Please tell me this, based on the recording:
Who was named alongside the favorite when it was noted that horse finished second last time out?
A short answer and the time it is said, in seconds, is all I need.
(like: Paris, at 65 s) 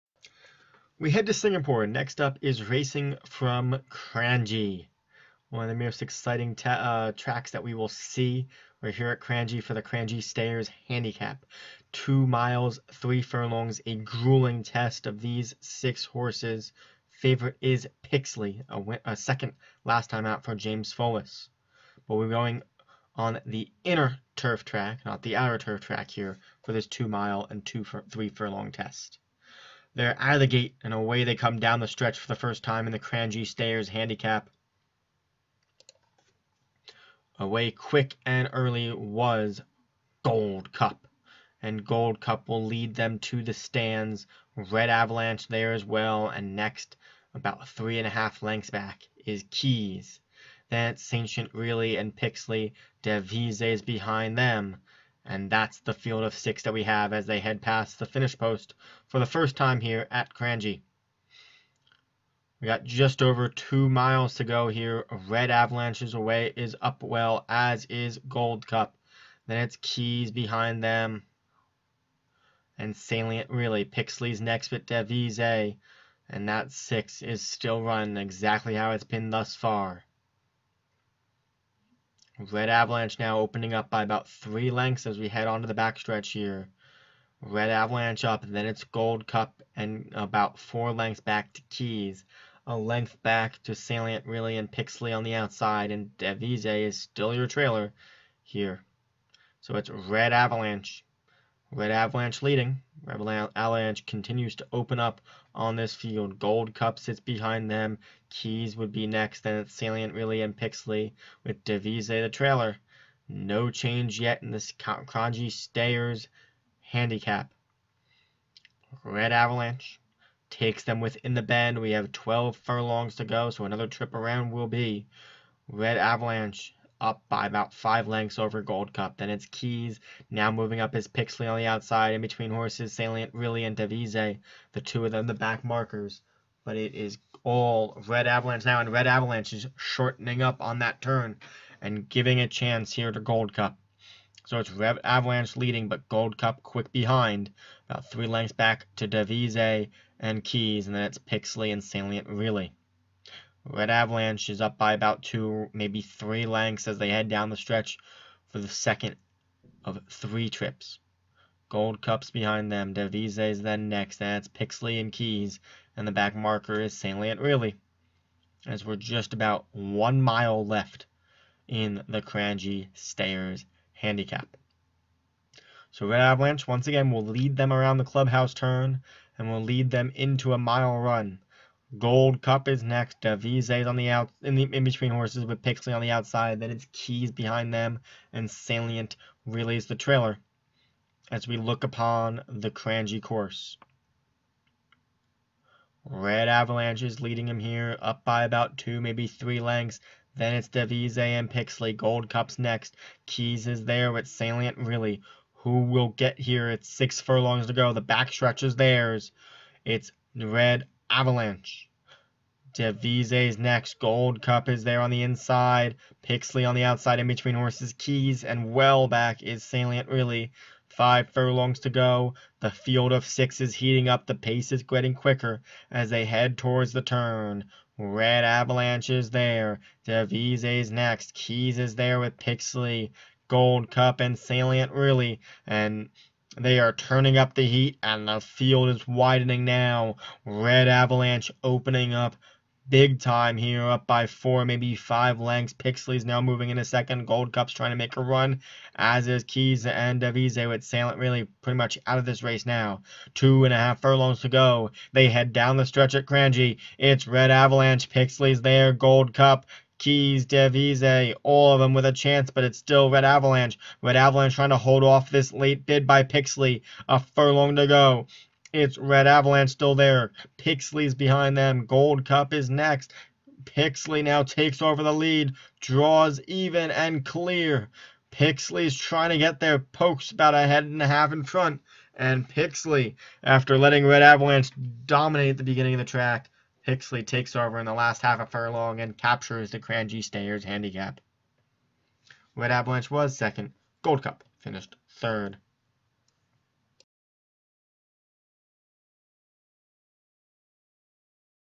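James Follis, at 20 s.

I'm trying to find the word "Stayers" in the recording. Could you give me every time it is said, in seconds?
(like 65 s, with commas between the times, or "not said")
10 s, 33 s, 115 s, 172 s, 290 s.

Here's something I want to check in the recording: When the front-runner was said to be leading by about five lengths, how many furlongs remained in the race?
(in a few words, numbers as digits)
12.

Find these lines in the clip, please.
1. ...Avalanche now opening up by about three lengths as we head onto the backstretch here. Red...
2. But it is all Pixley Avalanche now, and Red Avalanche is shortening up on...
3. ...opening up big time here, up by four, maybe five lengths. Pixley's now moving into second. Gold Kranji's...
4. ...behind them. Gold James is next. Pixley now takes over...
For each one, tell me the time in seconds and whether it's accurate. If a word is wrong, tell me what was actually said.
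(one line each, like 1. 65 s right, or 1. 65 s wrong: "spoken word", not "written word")
1. 82 s right
2. 136 s wrong: "Red", not "Pixley"
3. 241 s wrong: "Cup", not "Kranji"
4. 271 s wrong: "Cup", not "James".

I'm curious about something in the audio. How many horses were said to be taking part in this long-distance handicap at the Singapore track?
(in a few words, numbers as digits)
6.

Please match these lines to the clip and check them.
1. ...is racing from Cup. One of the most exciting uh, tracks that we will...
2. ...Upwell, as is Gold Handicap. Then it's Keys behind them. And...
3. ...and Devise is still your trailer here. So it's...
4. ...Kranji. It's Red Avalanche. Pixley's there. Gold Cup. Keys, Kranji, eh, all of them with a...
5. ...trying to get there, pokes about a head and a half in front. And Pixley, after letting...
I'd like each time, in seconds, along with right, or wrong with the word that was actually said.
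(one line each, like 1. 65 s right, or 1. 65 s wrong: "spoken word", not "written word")
1. 2 s wrong: "Kranji", not "Cup"
2. 66 s wrong: "Cup", not "Handicap"
3. 95 s right
4. 256 s wrong: "Devise", not "Kranji"
5. 278 s right.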